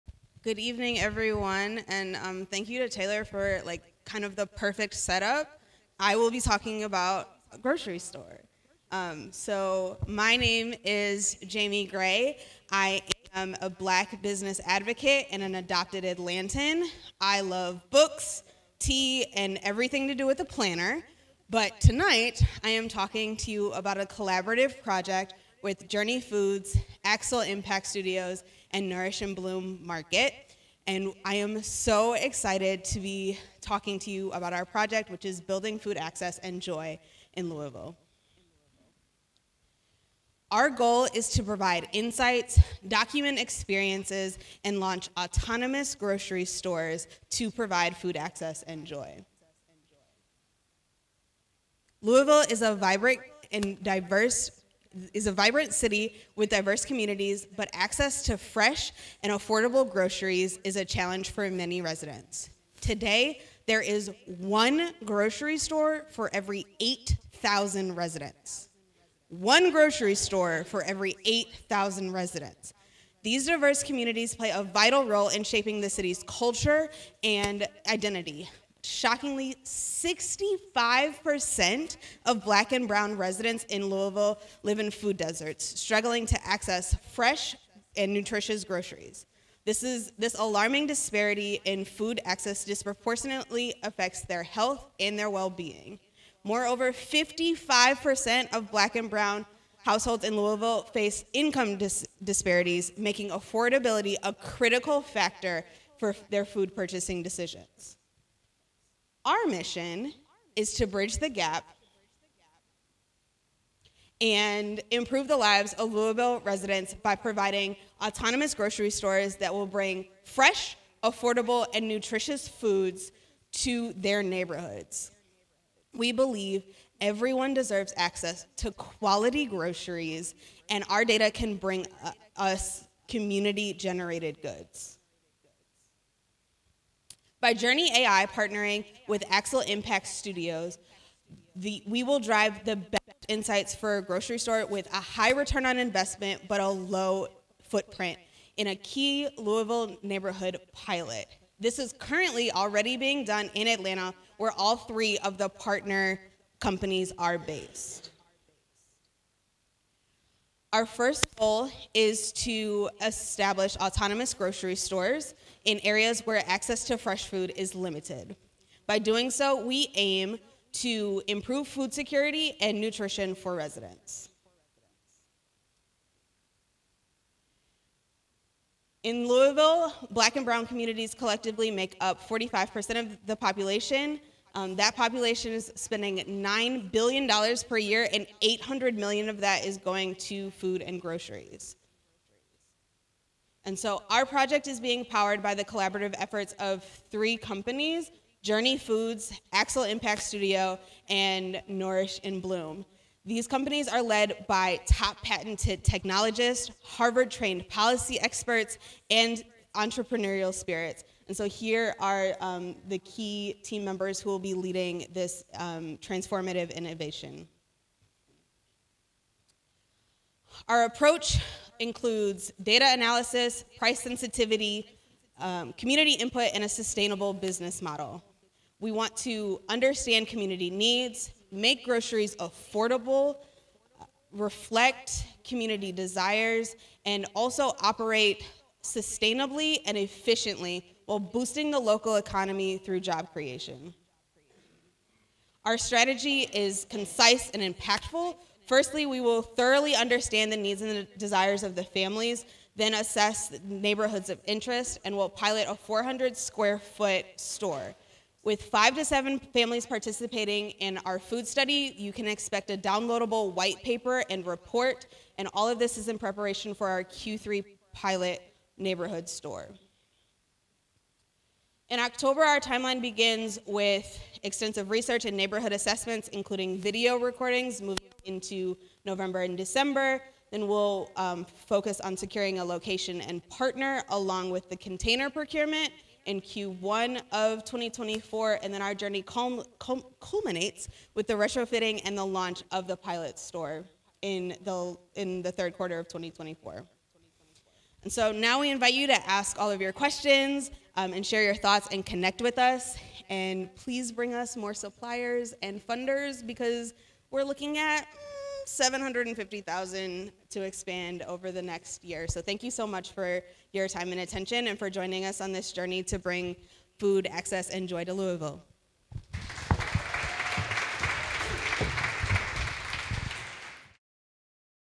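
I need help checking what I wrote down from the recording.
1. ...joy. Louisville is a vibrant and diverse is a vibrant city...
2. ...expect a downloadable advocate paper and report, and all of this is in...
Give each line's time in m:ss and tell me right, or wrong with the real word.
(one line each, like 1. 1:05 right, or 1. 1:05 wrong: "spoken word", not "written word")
1. 0:48 right
2. 4:22 wrong: "white", not "advocate".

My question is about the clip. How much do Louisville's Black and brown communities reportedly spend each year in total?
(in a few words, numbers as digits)
$9 billion.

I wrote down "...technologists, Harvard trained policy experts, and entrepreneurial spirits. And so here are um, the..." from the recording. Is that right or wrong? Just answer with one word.
right.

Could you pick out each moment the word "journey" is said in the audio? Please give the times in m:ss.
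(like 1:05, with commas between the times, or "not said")
0:25, 2:17, 3:18, 4:48, 5:15.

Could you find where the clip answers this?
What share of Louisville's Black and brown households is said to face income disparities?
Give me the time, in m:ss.
1:36.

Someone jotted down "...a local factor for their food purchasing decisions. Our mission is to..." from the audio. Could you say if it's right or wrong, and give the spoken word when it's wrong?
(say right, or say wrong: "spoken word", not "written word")
wrong: "critical", not "local".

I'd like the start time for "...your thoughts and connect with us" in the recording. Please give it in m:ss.
5:01.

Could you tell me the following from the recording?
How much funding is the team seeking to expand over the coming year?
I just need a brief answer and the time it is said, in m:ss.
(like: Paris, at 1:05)
750,000, at 5:08.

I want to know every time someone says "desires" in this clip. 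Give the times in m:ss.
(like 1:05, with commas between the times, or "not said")
3:55, 4:11.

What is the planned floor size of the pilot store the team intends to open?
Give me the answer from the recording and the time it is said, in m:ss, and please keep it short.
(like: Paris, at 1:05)
400 square feet, at 4:15.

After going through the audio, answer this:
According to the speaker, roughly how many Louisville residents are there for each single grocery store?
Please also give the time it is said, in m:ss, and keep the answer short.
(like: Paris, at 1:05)
8,000, at 1:11.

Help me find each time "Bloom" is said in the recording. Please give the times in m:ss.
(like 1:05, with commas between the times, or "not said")
0:29, 3:22.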